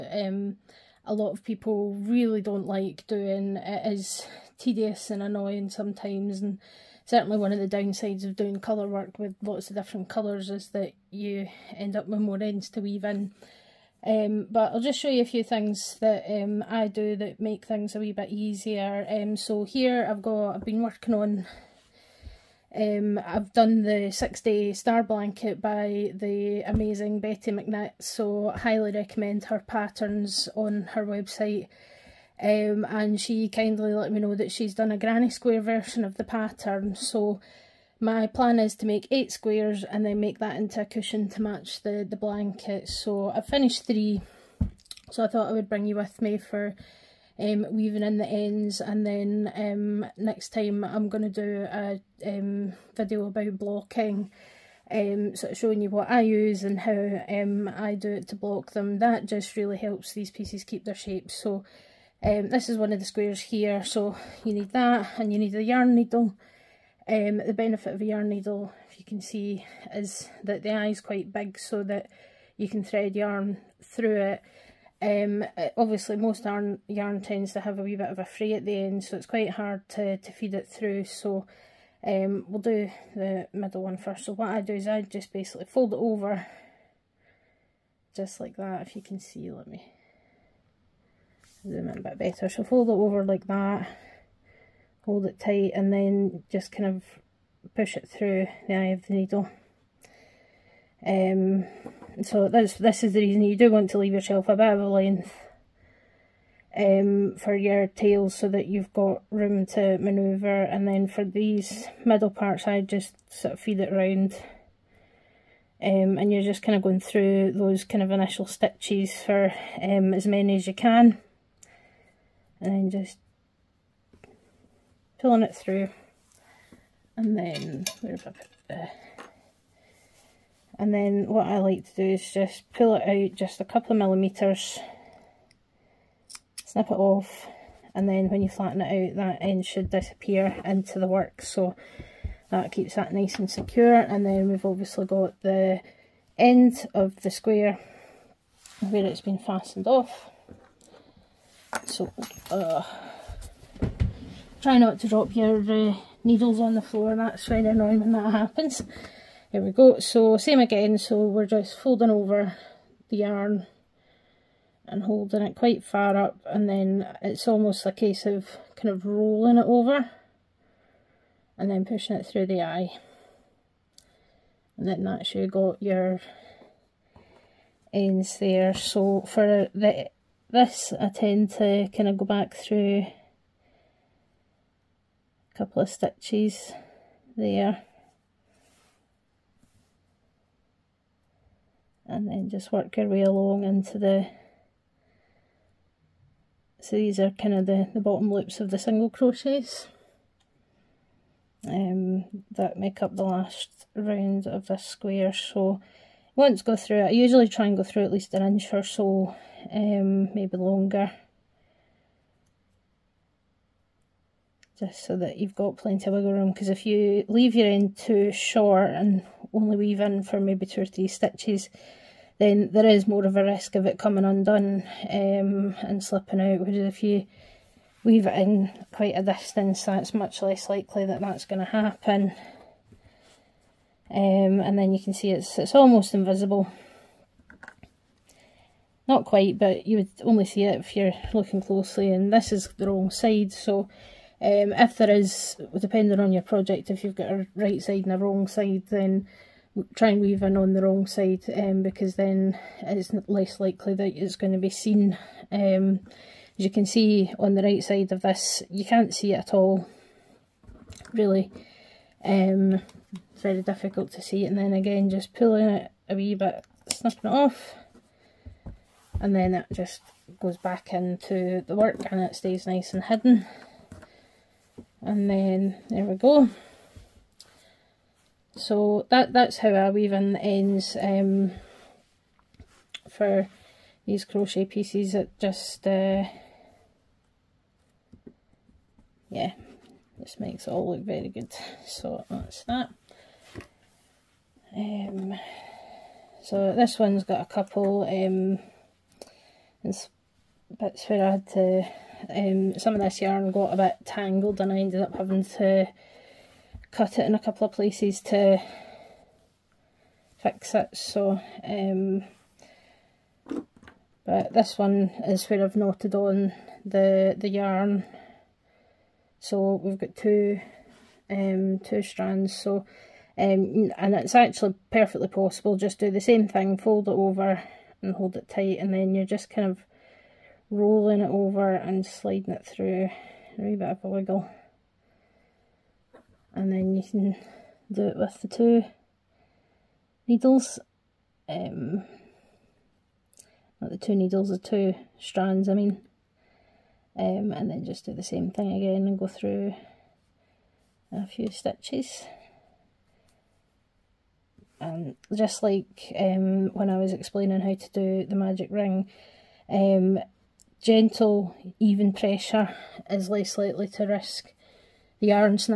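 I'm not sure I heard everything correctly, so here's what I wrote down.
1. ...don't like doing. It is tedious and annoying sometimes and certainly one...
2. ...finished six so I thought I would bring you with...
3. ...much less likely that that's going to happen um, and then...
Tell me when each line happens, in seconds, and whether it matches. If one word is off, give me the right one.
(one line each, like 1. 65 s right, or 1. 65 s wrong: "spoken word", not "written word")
1. 2 s right
2. 43 s wrong: "three", not "six"
3. 230 s right.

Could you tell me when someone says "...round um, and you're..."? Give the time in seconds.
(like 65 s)
113 s.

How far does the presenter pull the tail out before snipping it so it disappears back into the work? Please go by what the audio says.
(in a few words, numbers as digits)
A couple of millimetres.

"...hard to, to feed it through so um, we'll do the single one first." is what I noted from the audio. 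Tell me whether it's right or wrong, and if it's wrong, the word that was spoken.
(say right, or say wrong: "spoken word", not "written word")
wrong: "middle", not "single".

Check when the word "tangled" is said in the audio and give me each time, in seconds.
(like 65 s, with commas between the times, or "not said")
304 s.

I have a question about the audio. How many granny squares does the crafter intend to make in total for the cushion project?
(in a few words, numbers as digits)
8.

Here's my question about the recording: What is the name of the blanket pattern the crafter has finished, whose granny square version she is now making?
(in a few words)
Six day star blanket.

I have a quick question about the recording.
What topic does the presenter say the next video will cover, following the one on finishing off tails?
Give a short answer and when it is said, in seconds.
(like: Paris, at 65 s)
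Blocking, at 53 s.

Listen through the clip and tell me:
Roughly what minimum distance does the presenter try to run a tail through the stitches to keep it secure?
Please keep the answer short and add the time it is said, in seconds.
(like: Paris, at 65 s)
An inch, at 208 s.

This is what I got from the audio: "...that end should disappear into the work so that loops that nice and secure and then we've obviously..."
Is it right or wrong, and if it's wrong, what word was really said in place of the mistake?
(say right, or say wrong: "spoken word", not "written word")
wrong: "keeps", not "loops".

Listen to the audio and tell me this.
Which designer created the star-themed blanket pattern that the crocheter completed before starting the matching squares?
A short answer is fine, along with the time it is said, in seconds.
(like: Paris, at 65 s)
Betty McKnit, at 27 s.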